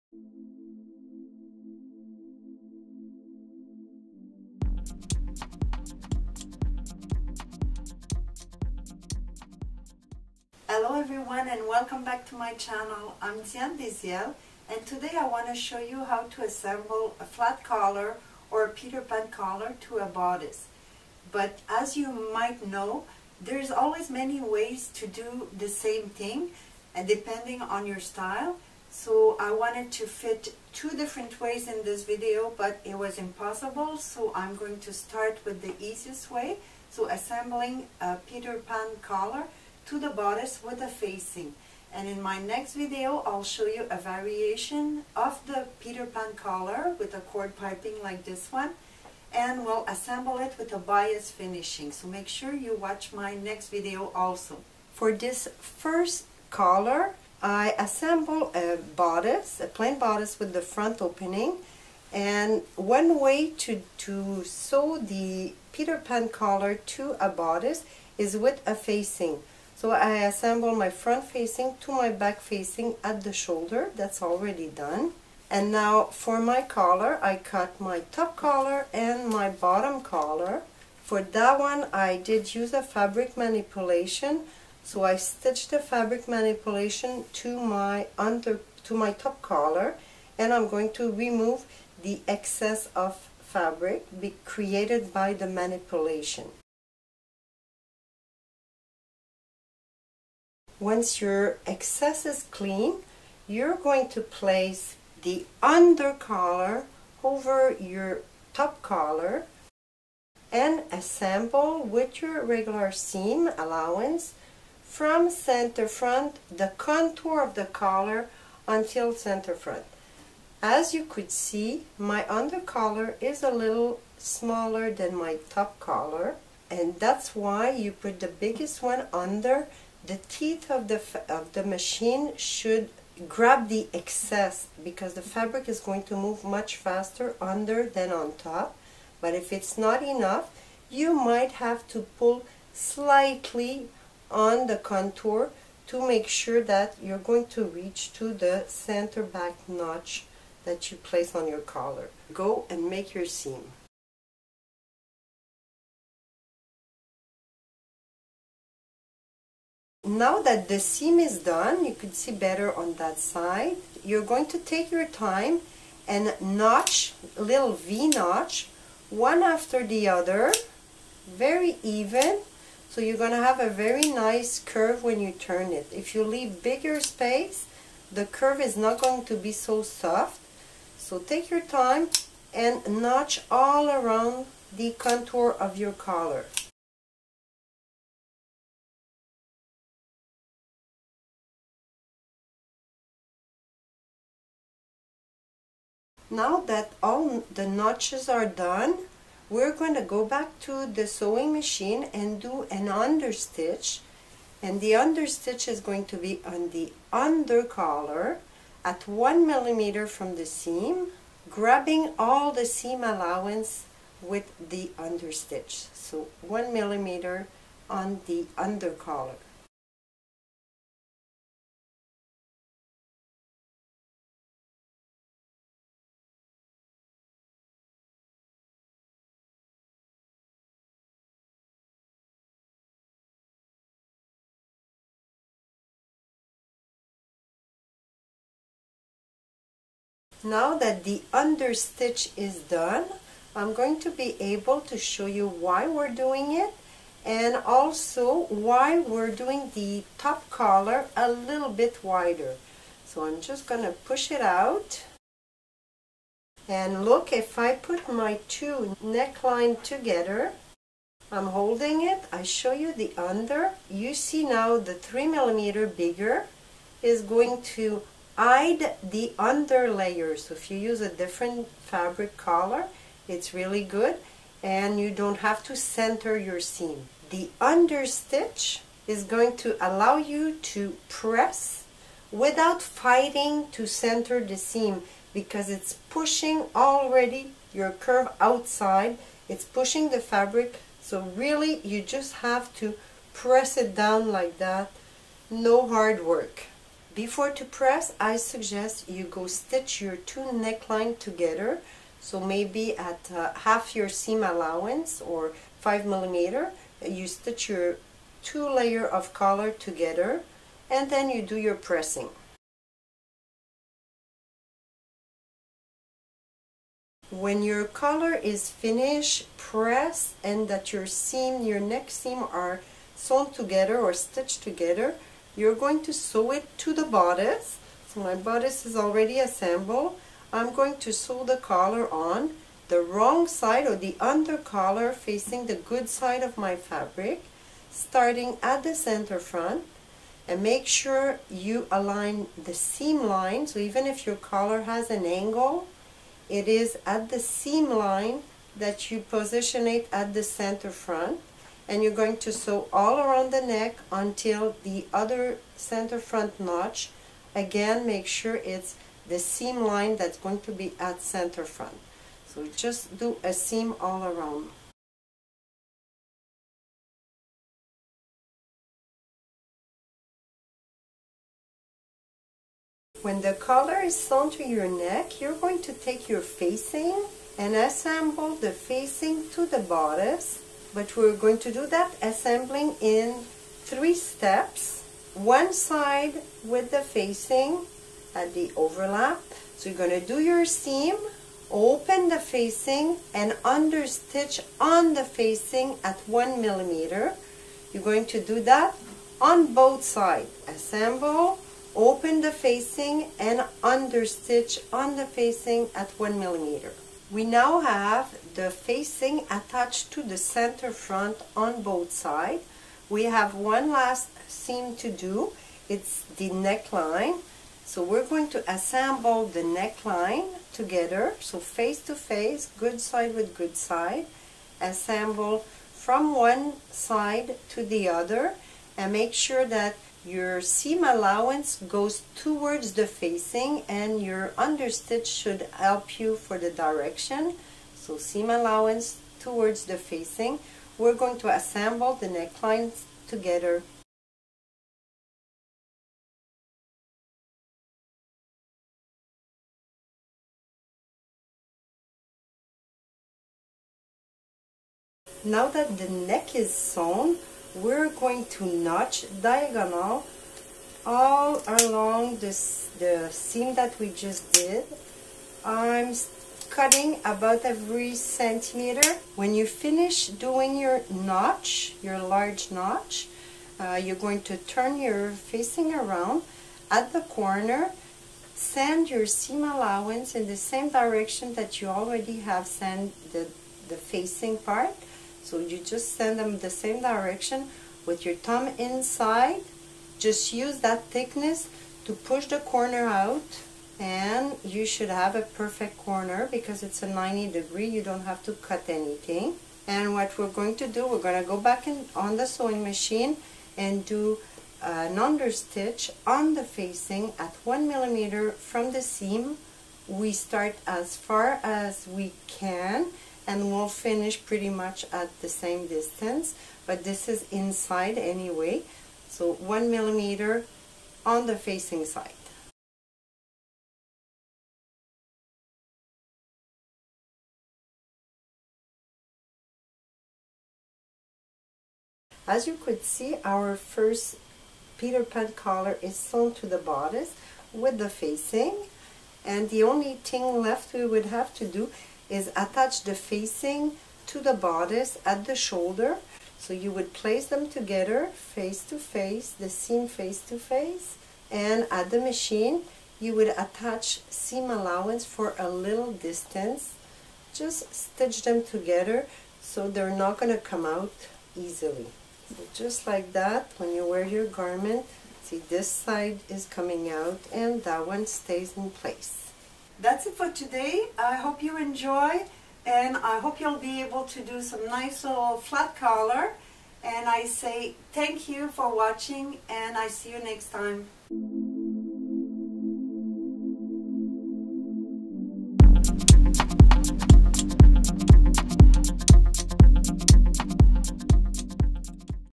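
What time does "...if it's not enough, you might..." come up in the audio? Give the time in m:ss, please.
2:19.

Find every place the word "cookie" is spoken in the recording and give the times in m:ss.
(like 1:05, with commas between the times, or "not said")
not said.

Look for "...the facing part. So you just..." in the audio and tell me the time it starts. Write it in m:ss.
8:03.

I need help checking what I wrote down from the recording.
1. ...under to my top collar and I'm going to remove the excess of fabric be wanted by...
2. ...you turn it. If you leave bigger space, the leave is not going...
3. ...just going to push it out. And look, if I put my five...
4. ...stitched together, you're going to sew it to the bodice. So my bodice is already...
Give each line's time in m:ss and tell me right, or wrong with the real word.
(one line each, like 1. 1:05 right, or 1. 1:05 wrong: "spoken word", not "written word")
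1. 1:28 wrong: "created", not "wanted"
2. 2:55 wrong: "curve", not "leave"
3. 4:13 wrong: "two", not "five"
4. 5:24 right.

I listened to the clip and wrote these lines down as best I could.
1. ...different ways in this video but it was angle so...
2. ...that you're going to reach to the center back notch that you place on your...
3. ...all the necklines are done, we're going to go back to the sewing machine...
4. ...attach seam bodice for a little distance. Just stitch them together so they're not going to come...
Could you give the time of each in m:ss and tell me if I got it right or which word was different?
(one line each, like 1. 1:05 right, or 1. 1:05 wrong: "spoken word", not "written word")
1. 0:30 wrong: "impossible", not "angle"
2. 2:26 right
3. 3:17 wrong: "notches", not "necklines"
4. 9:13 wrong: "allowance", not "bodice".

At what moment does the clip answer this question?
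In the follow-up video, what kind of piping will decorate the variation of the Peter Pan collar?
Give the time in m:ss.
0:47.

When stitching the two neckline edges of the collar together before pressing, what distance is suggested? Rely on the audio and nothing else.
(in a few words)
5 millimeters.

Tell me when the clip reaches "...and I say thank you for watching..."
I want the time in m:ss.
9:37.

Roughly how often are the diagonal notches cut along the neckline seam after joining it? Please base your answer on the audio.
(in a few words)
every centimeter.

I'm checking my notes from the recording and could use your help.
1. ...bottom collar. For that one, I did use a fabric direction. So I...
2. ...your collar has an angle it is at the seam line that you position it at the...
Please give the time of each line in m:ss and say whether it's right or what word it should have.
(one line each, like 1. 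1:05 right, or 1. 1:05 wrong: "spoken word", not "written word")
1. 1:19 wrong: "manipulation", not "direction"
2. 5:44 right.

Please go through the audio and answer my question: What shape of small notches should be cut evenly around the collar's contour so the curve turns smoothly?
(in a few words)
V notch.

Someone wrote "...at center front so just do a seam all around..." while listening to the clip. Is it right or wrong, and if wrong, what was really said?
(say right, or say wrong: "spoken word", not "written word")
right.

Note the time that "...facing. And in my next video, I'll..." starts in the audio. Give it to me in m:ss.
0:40.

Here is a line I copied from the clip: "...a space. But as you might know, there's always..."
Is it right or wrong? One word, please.
wrong.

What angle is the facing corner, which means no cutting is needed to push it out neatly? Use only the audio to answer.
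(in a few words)
90 degrees.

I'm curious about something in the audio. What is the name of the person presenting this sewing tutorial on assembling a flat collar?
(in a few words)
Diane Deziel.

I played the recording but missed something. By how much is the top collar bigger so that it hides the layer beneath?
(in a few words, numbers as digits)
3 millimeters.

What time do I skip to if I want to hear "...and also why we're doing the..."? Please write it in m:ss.
4:07.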